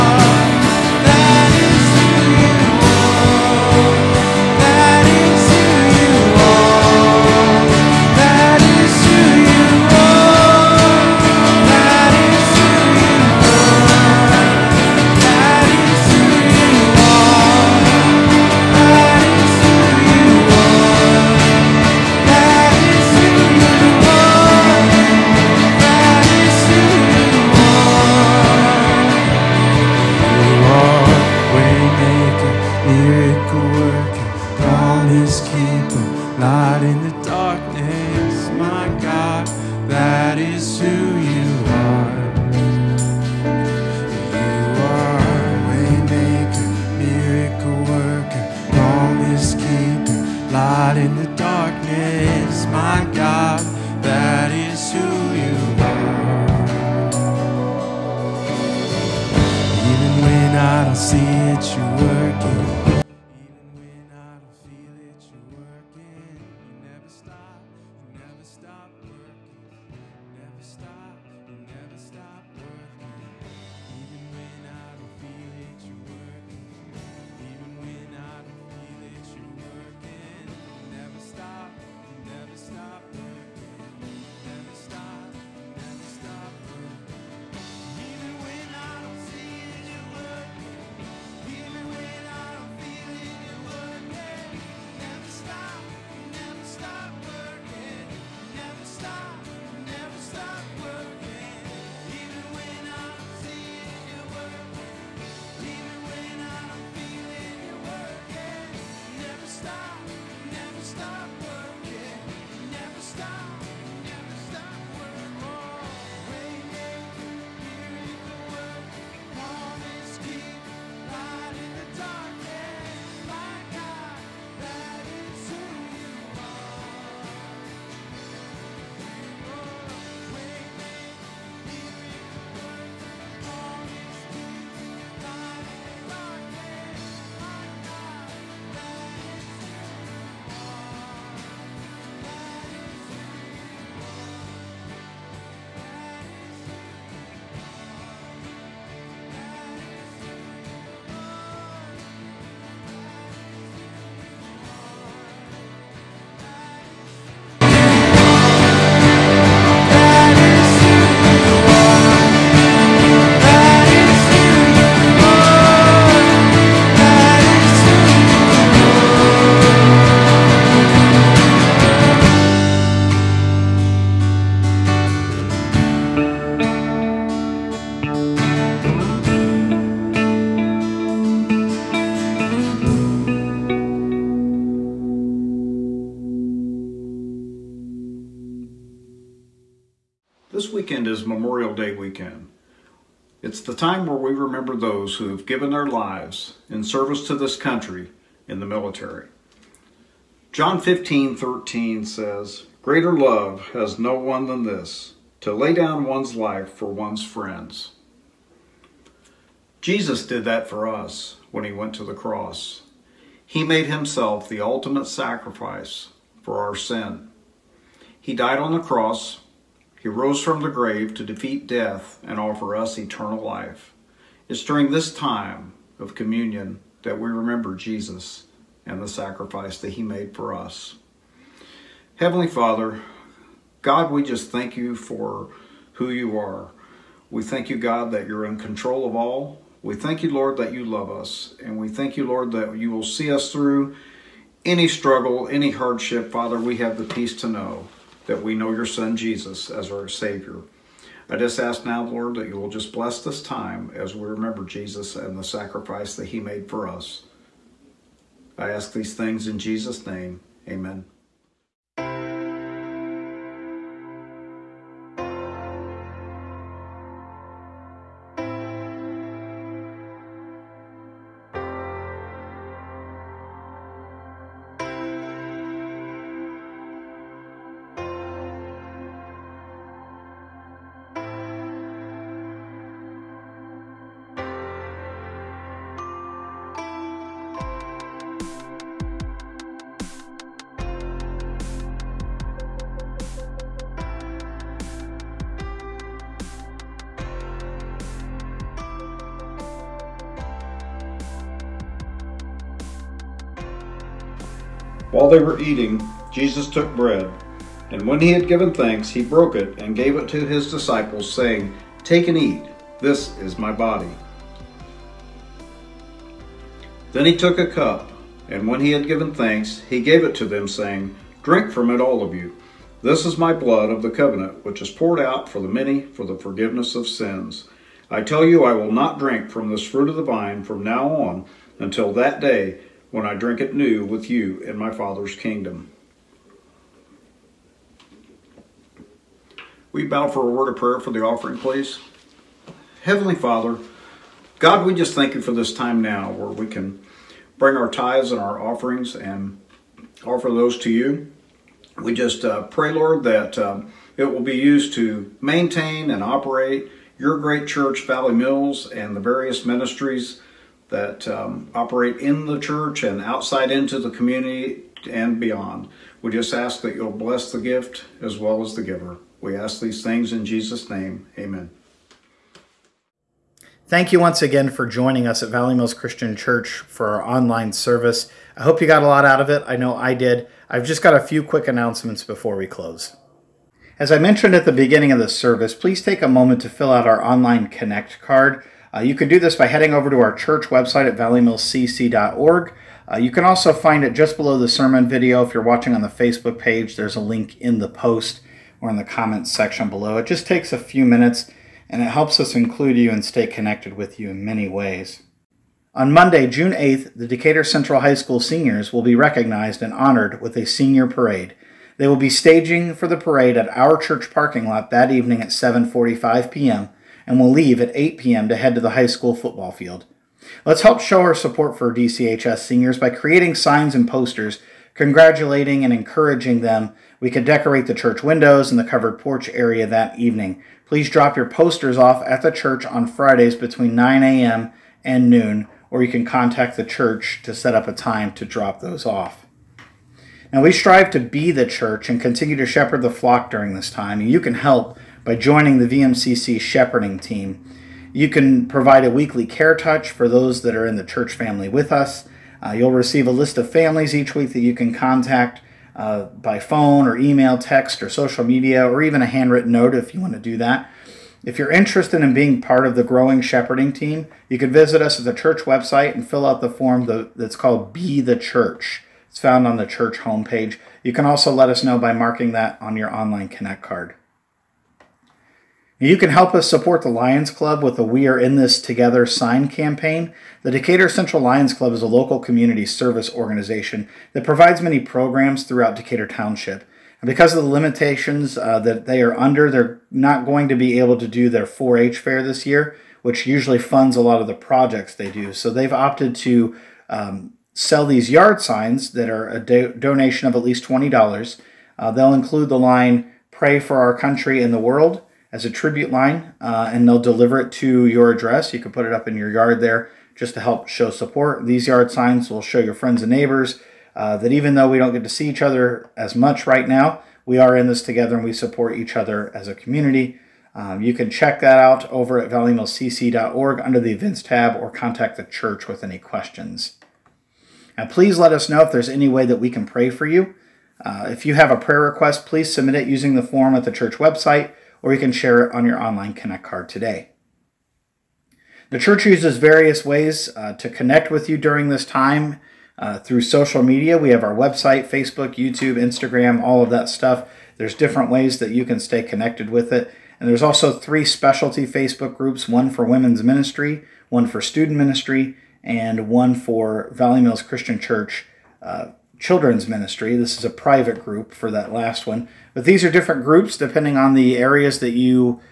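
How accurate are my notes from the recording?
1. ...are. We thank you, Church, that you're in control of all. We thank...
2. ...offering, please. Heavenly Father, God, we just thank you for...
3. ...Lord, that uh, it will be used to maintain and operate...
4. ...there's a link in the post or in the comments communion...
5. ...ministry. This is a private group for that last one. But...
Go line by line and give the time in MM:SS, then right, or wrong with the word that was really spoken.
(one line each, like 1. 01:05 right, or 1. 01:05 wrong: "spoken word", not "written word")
1. 03:56 wrong: "God", not "Church"
2. 05:41 right
3. 05:52 right
4. 06:36 wrong: "section", not "communion"
5. 09:19 right.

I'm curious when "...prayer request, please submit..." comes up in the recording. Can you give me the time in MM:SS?
08:51.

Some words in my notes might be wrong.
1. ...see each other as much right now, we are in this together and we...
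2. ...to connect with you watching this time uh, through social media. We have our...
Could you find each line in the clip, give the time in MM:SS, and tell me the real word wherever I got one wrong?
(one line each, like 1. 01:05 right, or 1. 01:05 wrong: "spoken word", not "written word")
1. 08:35 right
2. 09:00 wrong: "during", not "watching".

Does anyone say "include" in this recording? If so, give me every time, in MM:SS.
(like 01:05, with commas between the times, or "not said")
06:42, 08:22.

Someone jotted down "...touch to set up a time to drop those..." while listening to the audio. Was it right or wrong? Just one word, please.
wrong.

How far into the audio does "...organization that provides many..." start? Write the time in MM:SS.
08:03.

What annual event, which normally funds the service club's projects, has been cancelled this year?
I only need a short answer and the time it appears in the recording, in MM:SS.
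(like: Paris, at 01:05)
4 H fair, at 08:11.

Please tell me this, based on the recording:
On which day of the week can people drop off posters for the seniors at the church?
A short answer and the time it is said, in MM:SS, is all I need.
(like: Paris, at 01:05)
Fridays, at 07:13.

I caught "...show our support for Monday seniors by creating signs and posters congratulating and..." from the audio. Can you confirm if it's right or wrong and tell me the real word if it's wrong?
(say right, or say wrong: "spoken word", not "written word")
wrong: "DCHS", not "Monday".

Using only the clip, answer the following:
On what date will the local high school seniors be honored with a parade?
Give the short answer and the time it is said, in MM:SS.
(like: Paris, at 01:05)
June 8th, at 06:46.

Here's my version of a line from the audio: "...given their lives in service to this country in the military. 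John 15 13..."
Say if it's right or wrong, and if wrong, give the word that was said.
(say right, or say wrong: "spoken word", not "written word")
right.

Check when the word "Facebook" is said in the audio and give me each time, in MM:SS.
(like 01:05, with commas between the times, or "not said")
06:36, 09:05, 09:11.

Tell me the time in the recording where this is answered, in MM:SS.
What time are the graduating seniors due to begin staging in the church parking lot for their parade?
06:55.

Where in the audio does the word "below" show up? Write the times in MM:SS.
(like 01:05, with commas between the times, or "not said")
06:34, 06:39.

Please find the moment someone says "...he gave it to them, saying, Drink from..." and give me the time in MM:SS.
05:19.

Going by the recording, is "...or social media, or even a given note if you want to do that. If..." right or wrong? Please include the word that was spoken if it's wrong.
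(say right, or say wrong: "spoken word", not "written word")
wrong: "handwritten", not "given".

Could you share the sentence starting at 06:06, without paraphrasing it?
We just ask that you'll bless the gift as well as the giver.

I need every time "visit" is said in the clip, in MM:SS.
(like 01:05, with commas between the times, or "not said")
07:44.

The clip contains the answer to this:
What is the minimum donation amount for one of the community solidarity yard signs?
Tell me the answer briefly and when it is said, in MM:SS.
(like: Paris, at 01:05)
$20, at 08:20.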